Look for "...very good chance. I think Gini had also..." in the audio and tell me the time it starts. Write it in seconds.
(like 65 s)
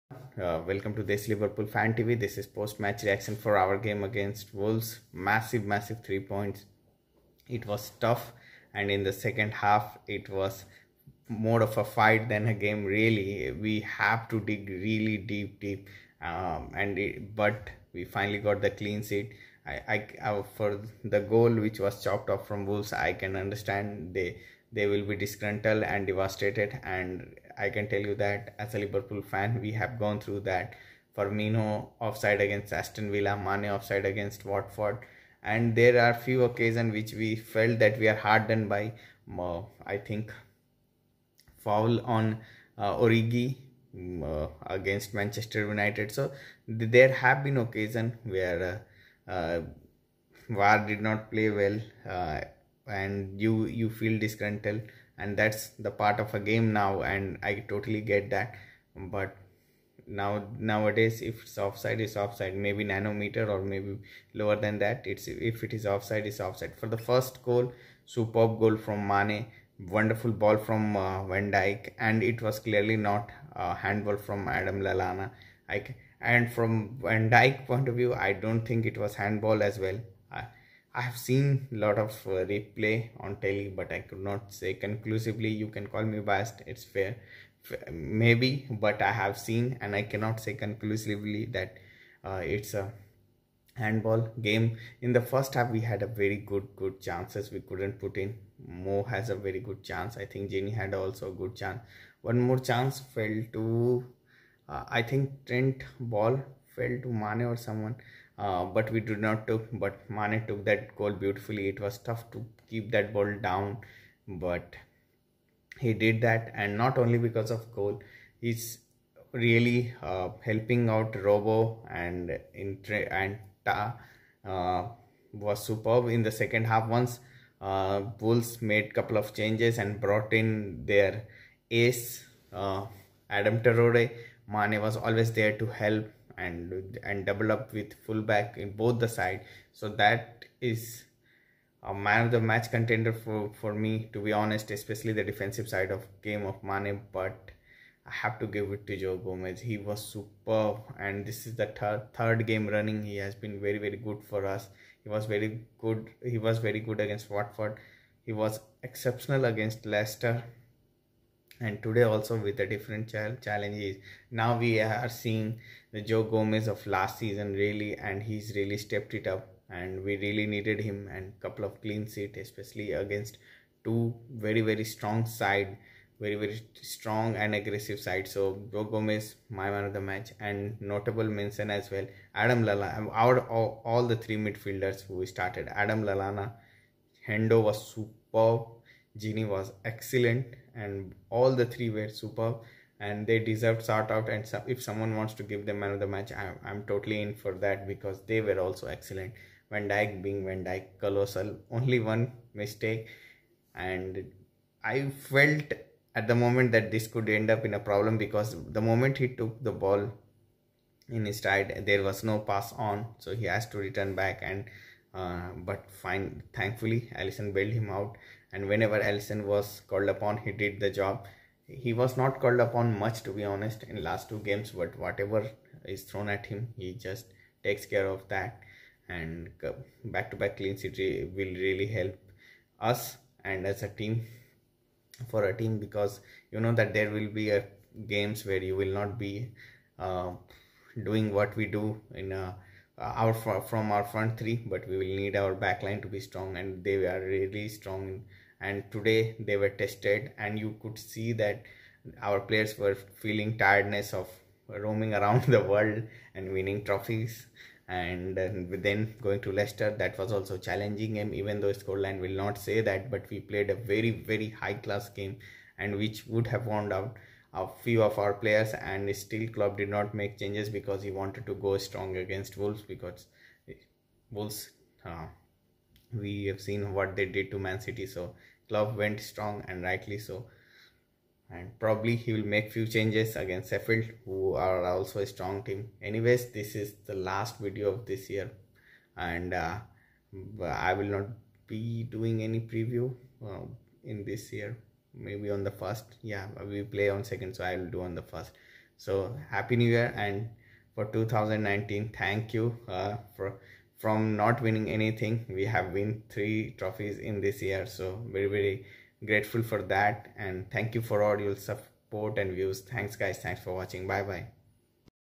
99 s.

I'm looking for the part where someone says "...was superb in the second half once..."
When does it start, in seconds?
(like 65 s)
125 s.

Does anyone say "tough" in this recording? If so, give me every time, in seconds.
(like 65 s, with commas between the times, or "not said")
7 s, 111 s.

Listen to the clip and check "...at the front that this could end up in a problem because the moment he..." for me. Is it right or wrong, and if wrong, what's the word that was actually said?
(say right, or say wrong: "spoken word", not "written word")
wrong: "moment", not "front".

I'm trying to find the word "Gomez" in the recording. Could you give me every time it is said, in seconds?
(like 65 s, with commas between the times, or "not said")
149 s, 166 s, 178 s.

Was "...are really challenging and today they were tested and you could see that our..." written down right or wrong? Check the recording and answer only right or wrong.
wrong.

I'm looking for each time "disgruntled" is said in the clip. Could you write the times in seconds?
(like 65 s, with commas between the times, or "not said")
25 s, 54 s.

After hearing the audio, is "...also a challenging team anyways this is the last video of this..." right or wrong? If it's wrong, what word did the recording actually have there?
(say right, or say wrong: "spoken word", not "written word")
wrong: "strong", not "challenging".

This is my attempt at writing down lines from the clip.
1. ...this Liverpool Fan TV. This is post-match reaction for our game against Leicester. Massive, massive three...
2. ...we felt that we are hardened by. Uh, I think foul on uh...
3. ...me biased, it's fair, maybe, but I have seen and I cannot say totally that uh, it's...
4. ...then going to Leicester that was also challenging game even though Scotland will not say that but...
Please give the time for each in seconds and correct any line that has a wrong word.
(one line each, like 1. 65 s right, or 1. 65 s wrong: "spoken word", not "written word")
1. 1 s wrong: "Wolves", not "Leicester"
2. 37 s right
3. 86 s wrong: "conclusively", not "totally"
4. 258 s right.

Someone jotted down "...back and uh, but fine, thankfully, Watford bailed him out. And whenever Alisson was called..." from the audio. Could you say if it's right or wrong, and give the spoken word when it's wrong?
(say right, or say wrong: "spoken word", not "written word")
wrong: "Alisson", not "Watford".